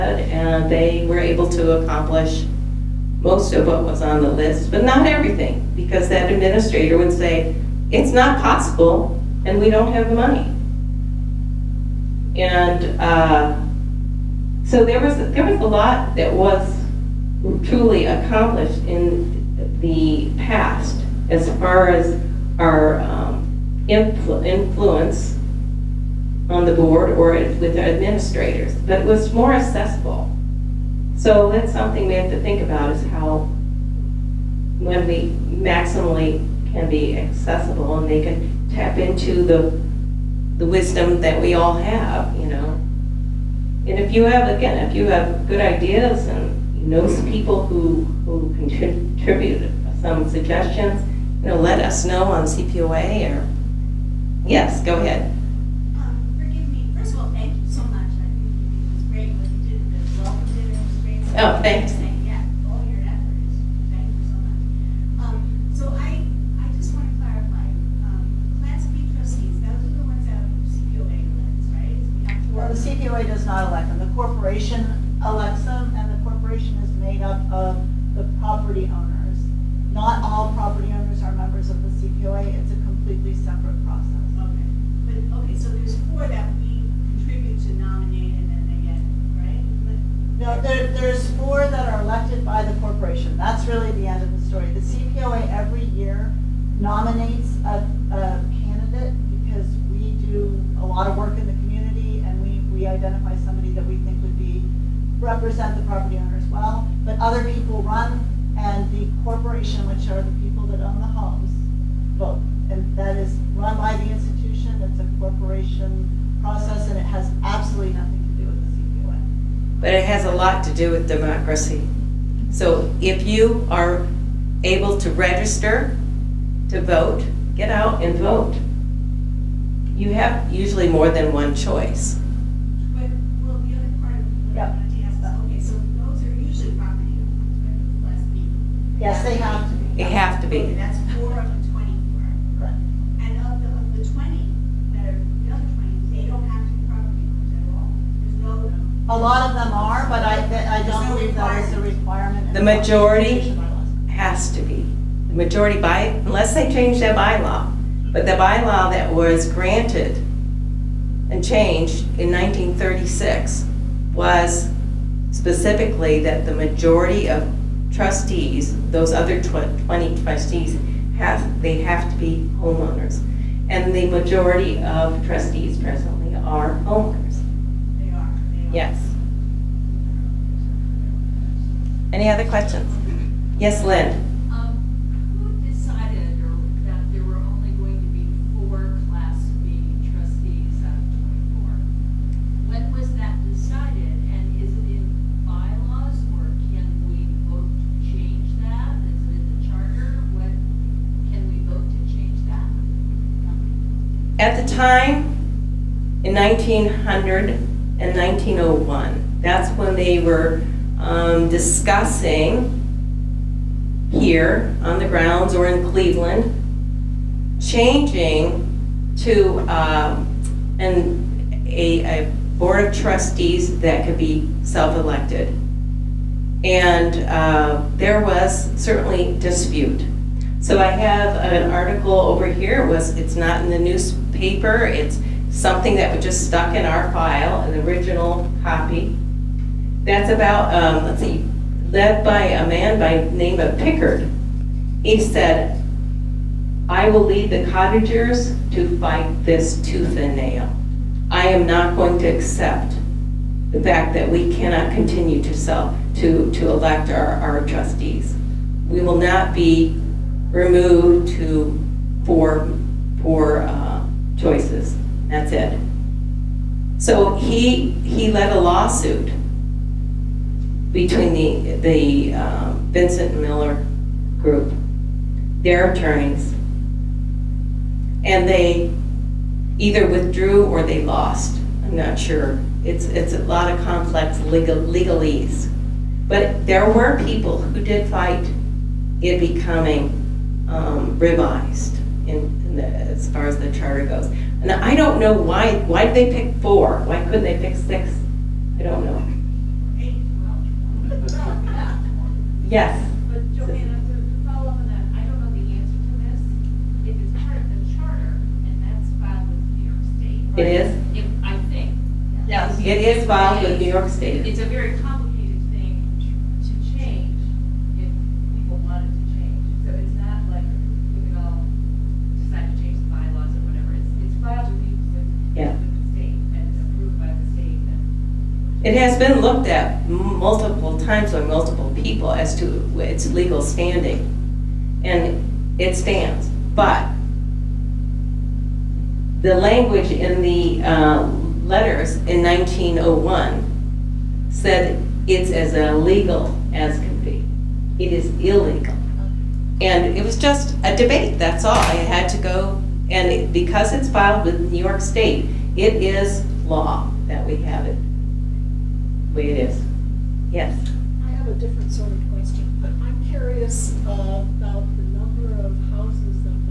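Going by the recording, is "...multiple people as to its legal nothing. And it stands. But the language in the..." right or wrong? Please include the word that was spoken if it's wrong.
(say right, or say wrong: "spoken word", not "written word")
wrong: "standing", not "nothing".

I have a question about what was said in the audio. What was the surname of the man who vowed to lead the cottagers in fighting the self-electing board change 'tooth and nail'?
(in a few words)
Pickard.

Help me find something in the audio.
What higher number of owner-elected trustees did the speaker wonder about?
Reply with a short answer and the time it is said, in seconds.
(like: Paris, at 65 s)
6, at 297 s.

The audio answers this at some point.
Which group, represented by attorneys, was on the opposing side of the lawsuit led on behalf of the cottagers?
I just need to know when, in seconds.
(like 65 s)
272 s.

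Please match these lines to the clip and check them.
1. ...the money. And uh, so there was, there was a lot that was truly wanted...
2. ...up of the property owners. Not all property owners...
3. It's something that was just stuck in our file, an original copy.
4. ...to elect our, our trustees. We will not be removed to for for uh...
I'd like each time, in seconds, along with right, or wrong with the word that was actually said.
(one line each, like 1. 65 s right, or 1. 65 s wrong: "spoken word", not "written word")
1. 10 s wrong: "accomplished", not "wanted"
2. 77 s right
3. 234 s right
4. 256 s right.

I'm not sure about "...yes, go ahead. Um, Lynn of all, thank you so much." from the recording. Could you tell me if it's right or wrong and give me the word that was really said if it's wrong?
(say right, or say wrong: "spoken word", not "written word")
wrong: "First", not "Lynn".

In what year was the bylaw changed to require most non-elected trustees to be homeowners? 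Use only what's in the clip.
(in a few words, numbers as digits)
1936.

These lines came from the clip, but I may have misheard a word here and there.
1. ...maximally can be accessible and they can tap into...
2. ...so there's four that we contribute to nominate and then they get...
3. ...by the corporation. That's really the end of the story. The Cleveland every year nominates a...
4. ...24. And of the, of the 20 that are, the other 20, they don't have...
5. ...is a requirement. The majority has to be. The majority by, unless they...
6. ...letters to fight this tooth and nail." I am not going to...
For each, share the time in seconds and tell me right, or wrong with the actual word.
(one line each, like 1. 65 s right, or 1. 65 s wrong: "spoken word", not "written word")
1. 35 s right
2. 85 s right
3. 92 s wrong: "CPOA", not "Cleveland"
4. 141 s right
5. 151 s right
6. 247 s wrong: "cottagers", not "letters".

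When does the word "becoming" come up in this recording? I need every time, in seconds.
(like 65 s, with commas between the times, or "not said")
289 s.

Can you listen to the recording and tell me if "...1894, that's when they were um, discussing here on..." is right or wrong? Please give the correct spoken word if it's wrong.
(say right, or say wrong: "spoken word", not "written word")
wrong: "1901", not "1894".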